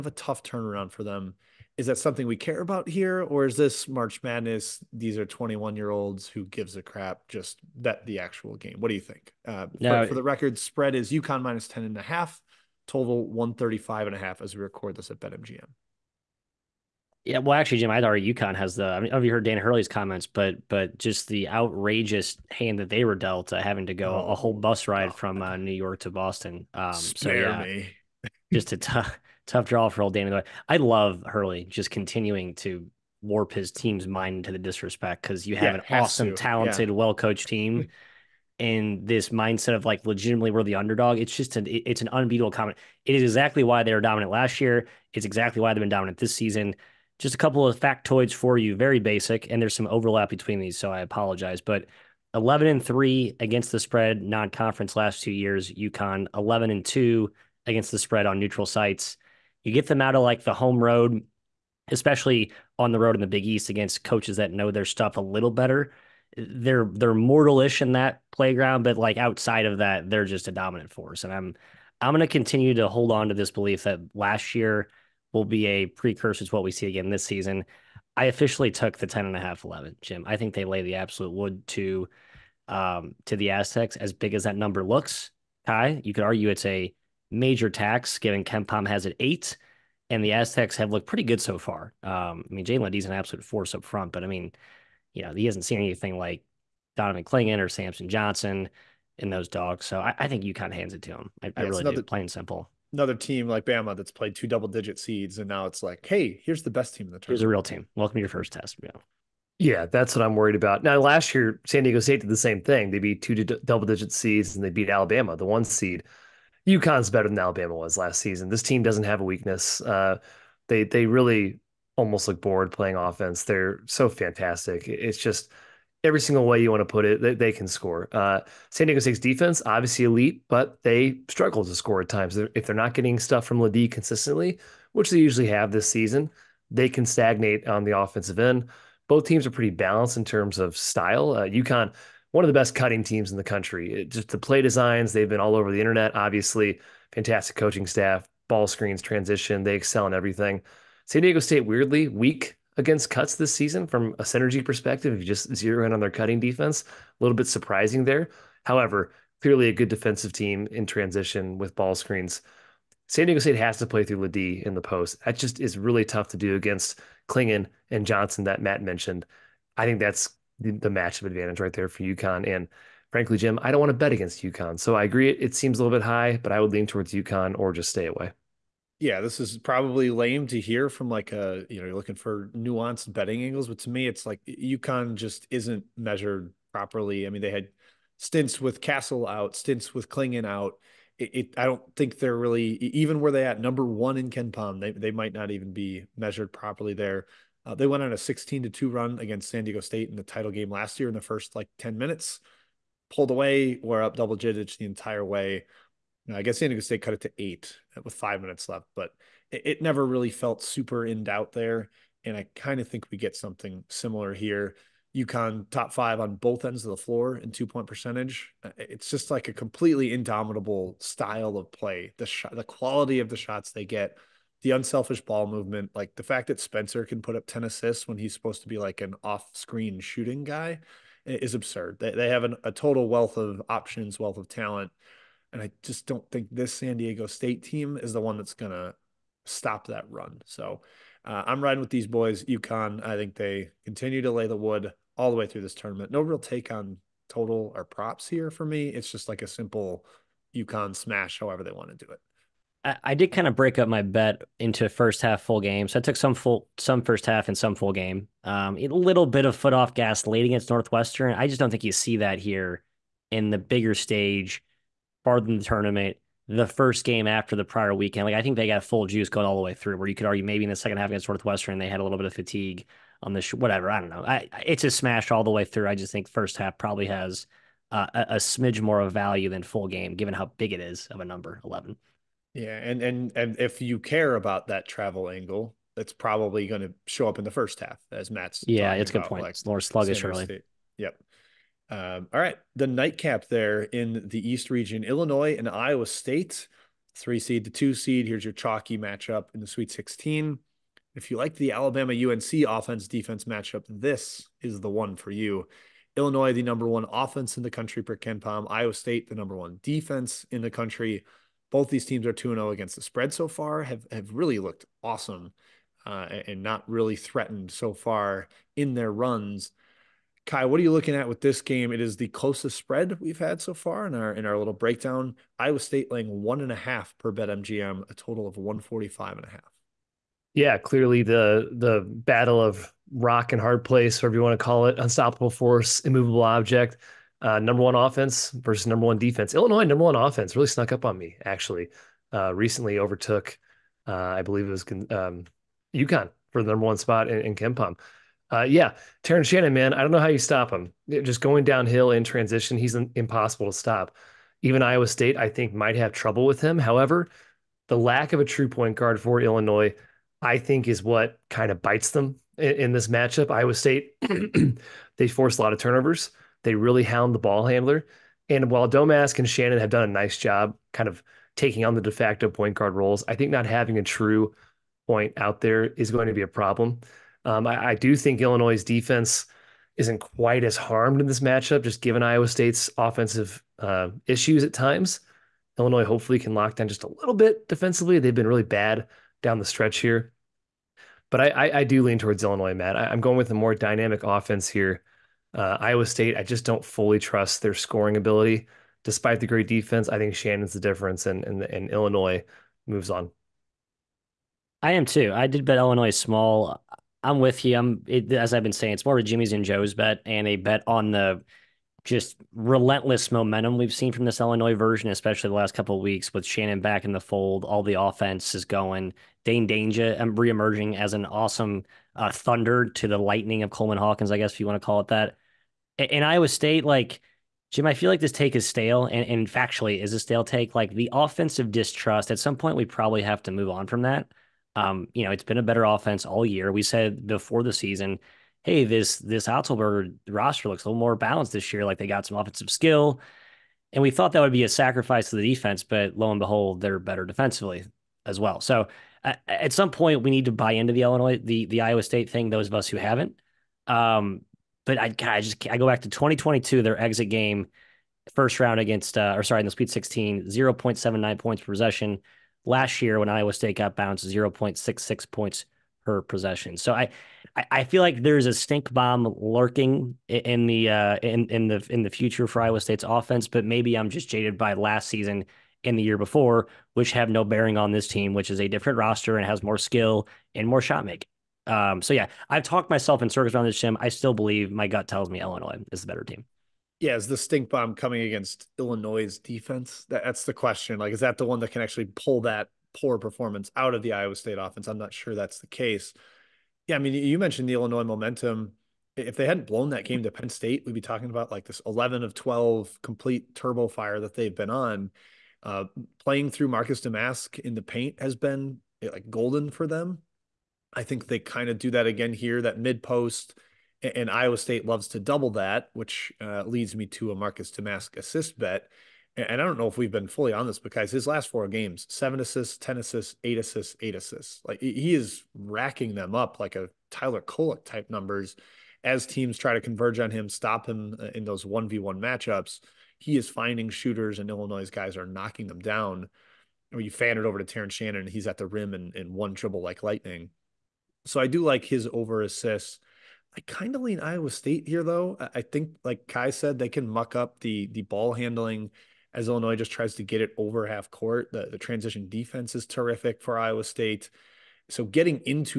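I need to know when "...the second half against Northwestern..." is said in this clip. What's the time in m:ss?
4:30.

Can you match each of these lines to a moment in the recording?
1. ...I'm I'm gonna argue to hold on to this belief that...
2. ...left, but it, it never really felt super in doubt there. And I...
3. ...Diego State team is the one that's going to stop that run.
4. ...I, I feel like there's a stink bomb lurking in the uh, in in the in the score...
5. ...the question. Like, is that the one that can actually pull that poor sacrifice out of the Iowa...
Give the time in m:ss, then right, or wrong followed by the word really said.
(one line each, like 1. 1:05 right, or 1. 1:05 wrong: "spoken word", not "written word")
1. 1:11 wrong: "continue", not "argue"
2. 3:28 right
3. 3:56 right
4. 7:46 wrong: "future", not "score"
5. 8:10 wrong: "performance", not "sacrifice".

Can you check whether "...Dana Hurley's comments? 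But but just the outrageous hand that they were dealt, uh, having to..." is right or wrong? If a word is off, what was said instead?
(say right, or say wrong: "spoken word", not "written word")
right.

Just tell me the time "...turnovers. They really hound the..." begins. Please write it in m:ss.
6:05.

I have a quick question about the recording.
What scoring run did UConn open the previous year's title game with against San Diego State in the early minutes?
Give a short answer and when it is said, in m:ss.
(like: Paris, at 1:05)
16 to 2, at 3:18.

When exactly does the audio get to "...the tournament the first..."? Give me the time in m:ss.
4:25.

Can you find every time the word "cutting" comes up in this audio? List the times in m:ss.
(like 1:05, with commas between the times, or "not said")
2:22, 2:36.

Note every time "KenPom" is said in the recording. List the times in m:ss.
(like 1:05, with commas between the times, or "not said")
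1:28, 3:14, 5:08, 5:47.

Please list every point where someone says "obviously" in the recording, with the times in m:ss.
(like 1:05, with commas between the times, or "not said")
2:09, 2:26.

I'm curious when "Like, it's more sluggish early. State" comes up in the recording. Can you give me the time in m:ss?
4:49.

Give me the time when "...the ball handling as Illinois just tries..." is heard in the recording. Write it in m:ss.
9:07.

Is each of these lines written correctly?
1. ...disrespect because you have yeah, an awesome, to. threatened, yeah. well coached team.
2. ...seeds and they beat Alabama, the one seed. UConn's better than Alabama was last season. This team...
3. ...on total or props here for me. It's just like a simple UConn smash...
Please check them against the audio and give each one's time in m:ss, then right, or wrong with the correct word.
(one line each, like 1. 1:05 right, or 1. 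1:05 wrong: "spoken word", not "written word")
1. 0:34 wrong: "talented", not "threatened"
2. 1:54 right
3. 4:06 right.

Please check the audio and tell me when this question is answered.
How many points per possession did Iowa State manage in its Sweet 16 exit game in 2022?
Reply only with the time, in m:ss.
7:40.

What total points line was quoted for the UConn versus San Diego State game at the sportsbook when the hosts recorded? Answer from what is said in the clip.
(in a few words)
135.5.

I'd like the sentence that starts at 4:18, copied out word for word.
Um, a little bit of foot off gas late against Northwestern.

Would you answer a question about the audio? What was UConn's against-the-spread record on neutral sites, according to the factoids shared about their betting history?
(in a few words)
11 and 2.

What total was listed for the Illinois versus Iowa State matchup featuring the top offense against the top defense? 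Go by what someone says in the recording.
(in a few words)
145.5.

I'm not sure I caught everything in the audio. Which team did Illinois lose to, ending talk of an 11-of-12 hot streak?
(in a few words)
Penn State.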